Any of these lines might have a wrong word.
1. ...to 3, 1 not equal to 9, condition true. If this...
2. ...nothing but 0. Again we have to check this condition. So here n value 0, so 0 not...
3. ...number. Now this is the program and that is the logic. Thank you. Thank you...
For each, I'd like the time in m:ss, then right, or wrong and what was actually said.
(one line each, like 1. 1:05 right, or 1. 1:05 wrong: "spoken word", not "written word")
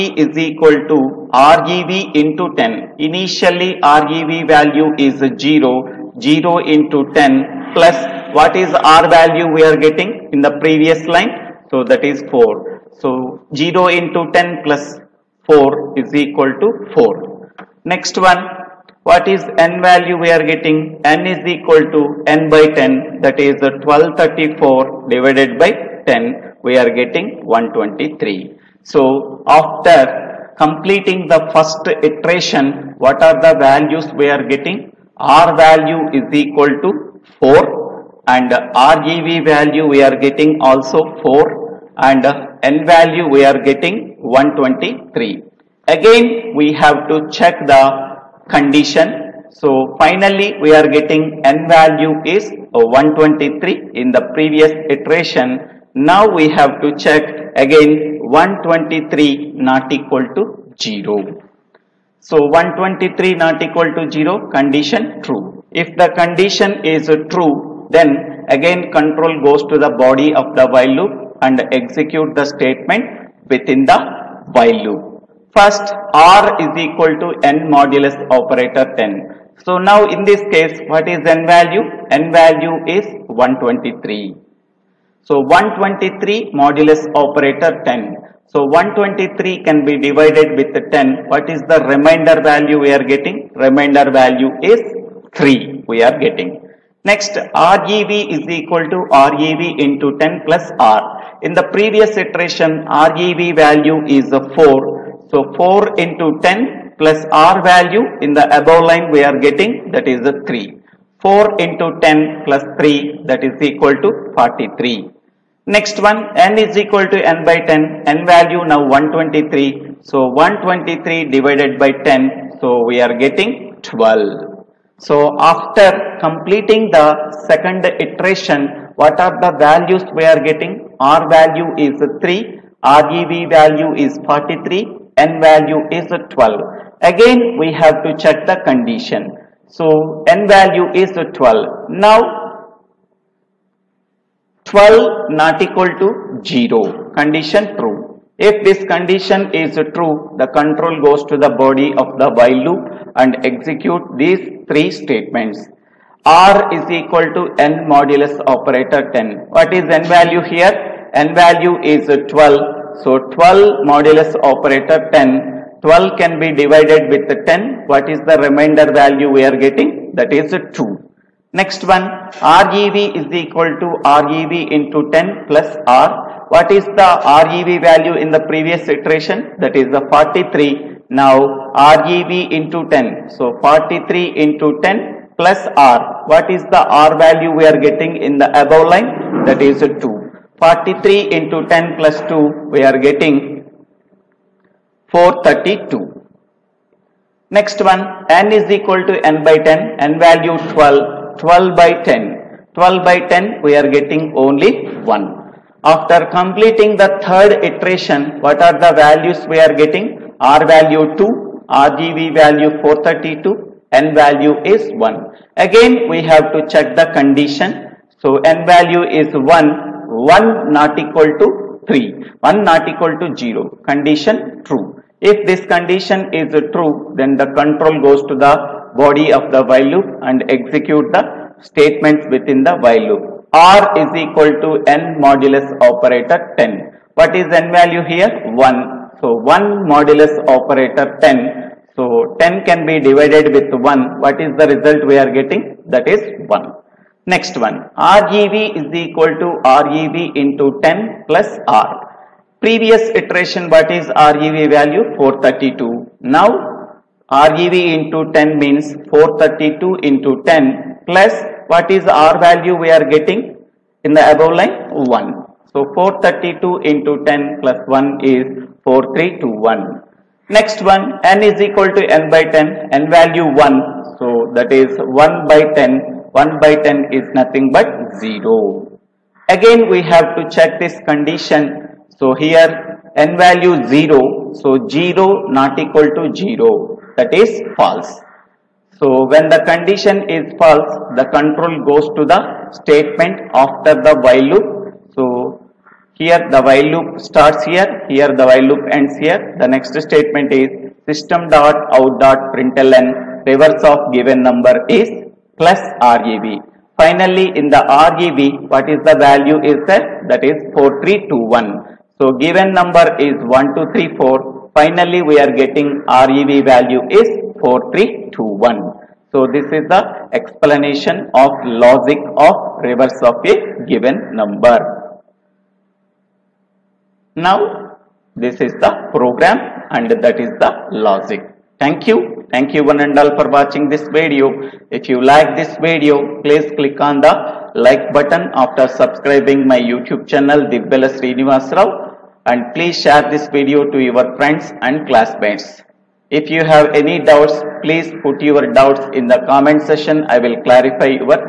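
1. 3:41 wrong: "0", not "9"
2. 4:37 right
3. 5:24 right.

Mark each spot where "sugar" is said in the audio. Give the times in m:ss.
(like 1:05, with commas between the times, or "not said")
not said.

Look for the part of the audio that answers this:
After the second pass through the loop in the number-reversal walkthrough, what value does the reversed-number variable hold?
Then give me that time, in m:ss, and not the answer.
2:12.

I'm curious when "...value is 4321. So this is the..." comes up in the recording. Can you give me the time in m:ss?
5:16.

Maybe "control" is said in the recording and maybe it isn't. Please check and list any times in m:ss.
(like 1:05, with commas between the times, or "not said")
1:08, 2:30, 3:47, 4:51.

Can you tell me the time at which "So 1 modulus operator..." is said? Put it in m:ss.
3:59.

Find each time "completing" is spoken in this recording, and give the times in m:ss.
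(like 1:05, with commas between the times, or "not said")
0:30, 2:06, 3:26.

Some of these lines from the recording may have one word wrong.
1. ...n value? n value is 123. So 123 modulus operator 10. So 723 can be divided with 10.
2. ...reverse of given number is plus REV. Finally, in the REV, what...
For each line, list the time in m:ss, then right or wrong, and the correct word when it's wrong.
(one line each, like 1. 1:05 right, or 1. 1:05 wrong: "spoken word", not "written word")
1. 1:21 wrong: "123", not "723"
2. 5:03 right.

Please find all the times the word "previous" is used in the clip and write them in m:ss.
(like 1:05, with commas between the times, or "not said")
0:10, 0:54, 1:41, 2:58, 4:12.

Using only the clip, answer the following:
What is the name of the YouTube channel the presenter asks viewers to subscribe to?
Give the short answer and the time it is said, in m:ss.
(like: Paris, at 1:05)
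Divvela Srinivas Rao, at 5:40.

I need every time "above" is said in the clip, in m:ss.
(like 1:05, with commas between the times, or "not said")
1:48, 3:08, 4:24.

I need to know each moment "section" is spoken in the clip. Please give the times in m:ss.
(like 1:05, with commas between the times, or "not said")
5:49.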